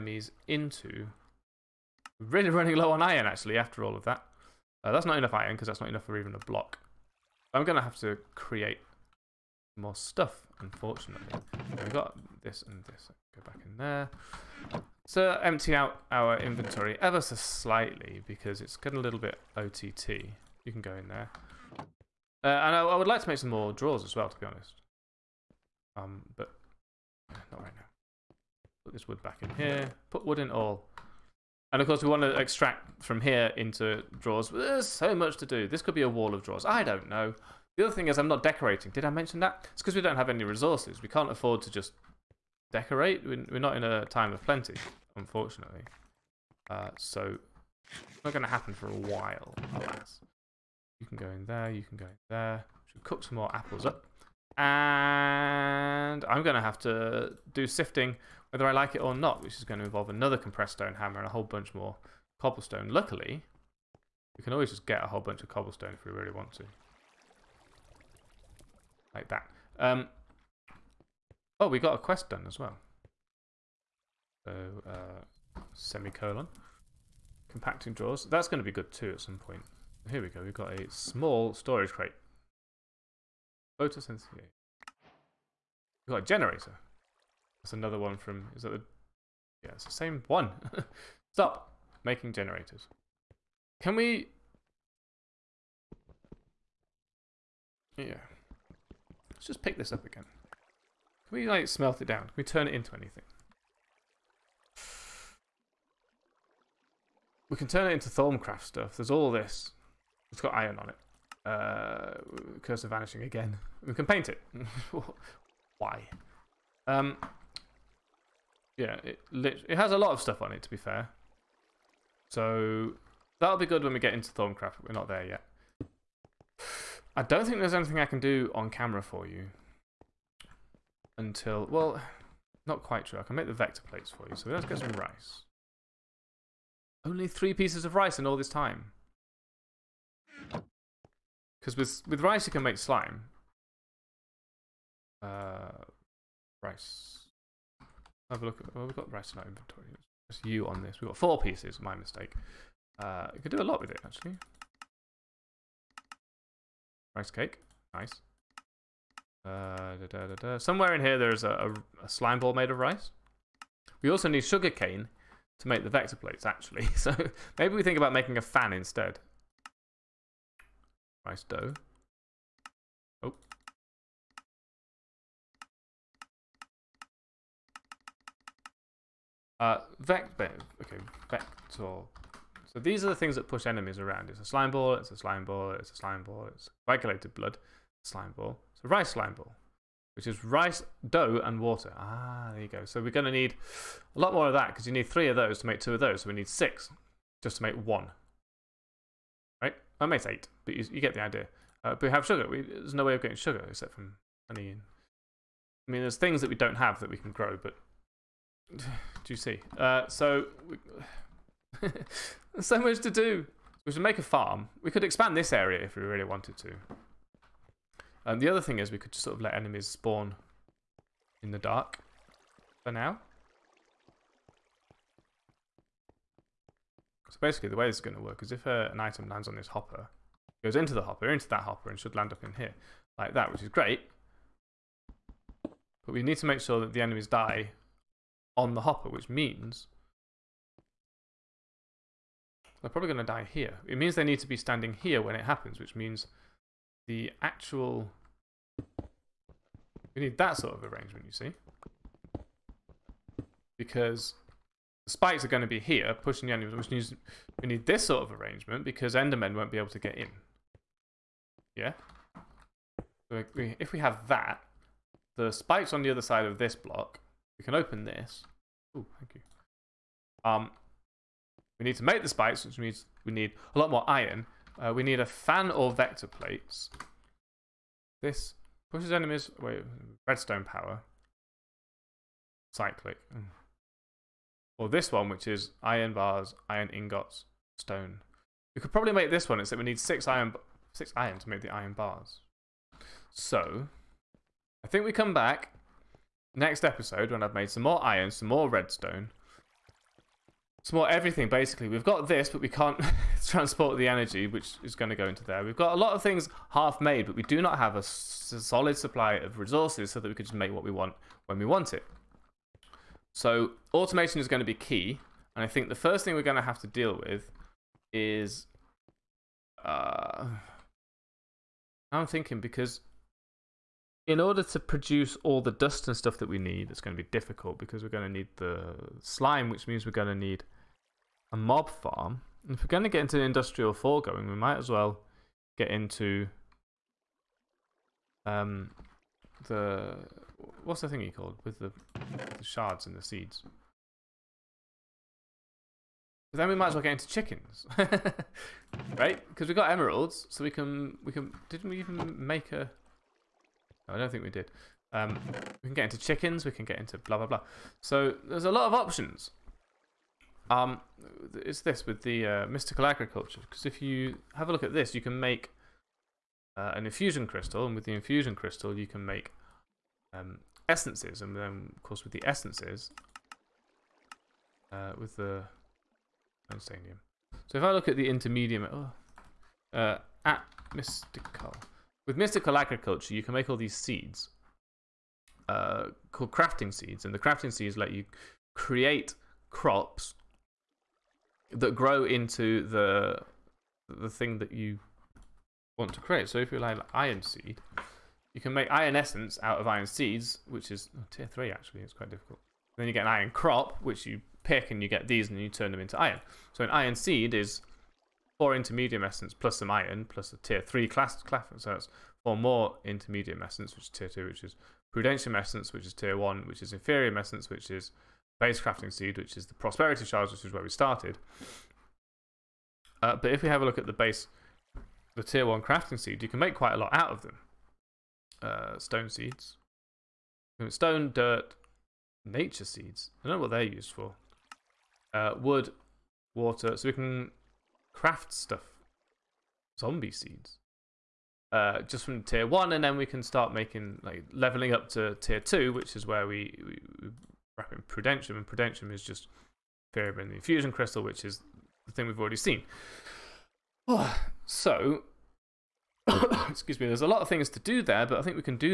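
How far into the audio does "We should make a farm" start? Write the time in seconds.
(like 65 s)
213 s.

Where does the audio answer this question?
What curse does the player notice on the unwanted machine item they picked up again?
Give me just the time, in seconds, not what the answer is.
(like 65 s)
112 s.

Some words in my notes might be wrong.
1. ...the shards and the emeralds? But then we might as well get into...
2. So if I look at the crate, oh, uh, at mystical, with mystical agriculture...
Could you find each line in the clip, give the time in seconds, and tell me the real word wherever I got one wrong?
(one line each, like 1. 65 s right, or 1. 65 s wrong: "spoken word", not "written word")
1. 342 s wrong: "seeds", not "emeralds"
2. 377 s wrong: "intermediate", not "crate".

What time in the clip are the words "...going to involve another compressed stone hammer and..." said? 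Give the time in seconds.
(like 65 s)
59 s.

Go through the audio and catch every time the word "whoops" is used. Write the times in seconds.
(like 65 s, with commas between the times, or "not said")
not said.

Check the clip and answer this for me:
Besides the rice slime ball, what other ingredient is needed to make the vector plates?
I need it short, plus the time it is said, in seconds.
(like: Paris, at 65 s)
Sugar cane, at 164 s.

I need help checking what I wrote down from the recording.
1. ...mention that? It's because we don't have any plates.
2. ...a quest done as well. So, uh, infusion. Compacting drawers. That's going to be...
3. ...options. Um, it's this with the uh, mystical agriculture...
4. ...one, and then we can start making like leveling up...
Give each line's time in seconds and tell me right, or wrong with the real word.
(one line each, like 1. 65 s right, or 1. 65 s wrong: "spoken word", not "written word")
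1. 39 s wrong: "resources", not "plates"
2. 71 s wrong: "semicolon", not "infusion"
3. 358 s right
4. 442 s right.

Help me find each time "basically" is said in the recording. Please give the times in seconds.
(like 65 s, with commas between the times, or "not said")
227 s, 301 s.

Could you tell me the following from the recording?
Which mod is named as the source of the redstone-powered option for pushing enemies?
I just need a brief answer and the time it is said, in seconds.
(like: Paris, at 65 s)
Cyclic, at 282 s.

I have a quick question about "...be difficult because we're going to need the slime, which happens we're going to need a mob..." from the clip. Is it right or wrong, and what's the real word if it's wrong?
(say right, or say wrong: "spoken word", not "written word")
wrong: "means", not "happens".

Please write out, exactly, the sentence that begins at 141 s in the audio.
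Because with, with rice, you can make slime.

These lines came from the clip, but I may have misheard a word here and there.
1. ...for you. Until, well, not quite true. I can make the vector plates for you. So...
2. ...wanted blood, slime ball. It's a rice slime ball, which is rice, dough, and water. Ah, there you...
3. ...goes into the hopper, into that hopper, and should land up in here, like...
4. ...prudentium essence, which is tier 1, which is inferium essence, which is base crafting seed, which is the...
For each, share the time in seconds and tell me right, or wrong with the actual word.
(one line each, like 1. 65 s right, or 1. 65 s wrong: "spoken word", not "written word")
1. 129 s right
2. 186 s wrong: "coagulated", not "wanted"
3. 230 s right
4. 415 s right.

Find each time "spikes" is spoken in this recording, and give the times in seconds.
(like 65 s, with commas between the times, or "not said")
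255 s, 265 s, 272 s.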